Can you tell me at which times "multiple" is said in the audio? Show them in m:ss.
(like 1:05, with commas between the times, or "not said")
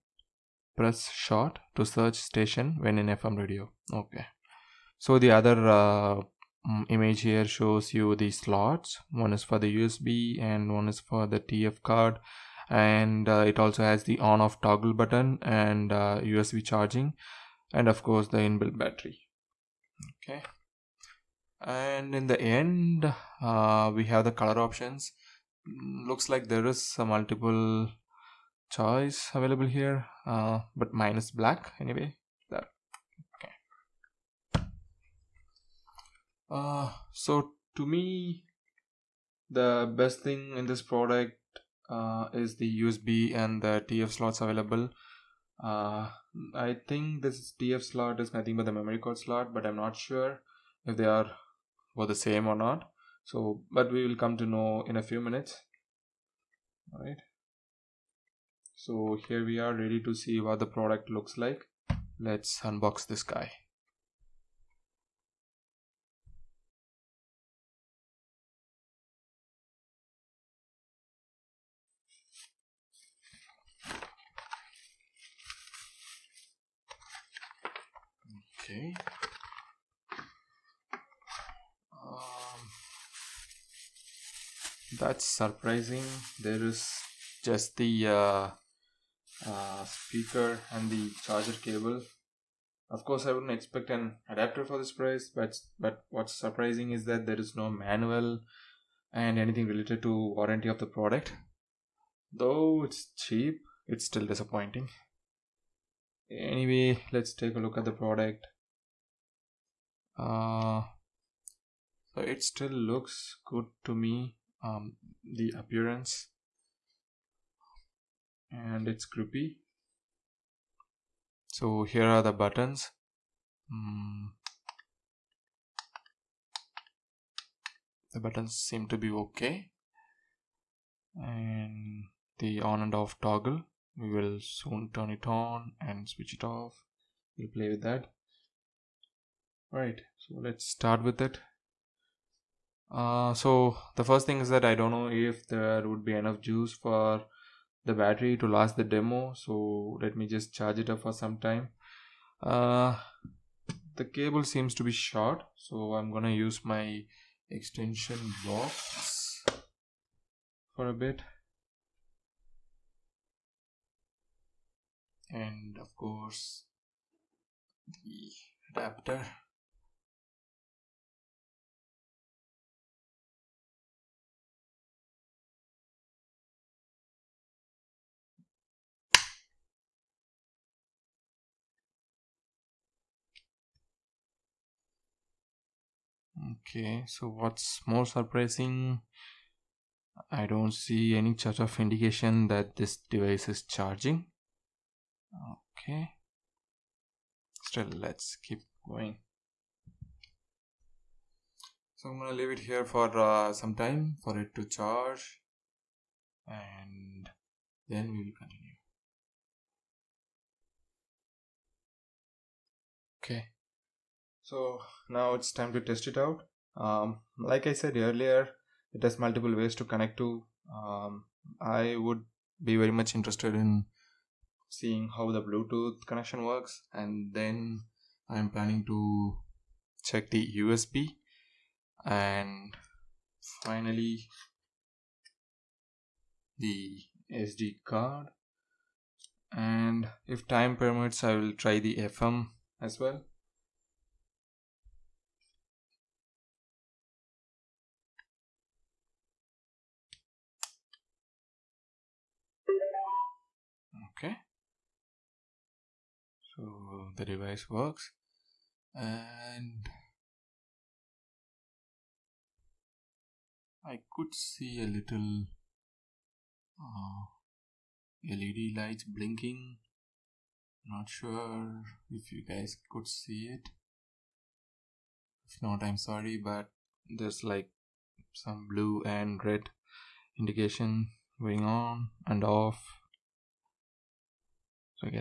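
0:27, 3:39.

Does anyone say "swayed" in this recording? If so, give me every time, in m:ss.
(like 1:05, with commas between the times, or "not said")
not said.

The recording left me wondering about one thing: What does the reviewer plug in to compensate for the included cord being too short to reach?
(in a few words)
Extension box.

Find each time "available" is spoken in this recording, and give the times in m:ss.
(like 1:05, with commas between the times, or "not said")
0:29, 0:44.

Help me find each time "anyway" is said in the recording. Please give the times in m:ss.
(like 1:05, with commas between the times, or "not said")
0:31, 1:46.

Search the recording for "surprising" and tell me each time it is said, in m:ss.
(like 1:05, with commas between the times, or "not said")
1:25, 1:36, 3:08.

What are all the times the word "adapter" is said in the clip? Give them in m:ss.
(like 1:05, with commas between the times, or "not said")
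1:34, 2:48.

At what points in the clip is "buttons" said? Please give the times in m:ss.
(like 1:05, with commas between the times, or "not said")
0:14, 2:02, 2:08.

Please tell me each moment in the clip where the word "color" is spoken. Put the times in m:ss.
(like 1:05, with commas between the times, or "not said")
0:24.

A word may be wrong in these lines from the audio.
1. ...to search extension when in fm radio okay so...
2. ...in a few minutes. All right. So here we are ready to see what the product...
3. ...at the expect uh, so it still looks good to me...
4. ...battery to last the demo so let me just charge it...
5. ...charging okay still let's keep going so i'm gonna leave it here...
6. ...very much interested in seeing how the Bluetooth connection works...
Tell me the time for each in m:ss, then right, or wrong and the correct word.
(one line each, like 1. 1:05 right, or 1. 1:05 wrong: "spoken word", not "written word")
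1. 0:01 wrong: "station", not "extension"
2. 0:54 right
3. 1:47 wrong: "product", not "expect"
4. 2:27 right
5. 3:13 right
6. 3:42 right.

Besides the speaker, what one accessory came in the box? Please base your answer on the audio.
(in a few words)
Charger cable.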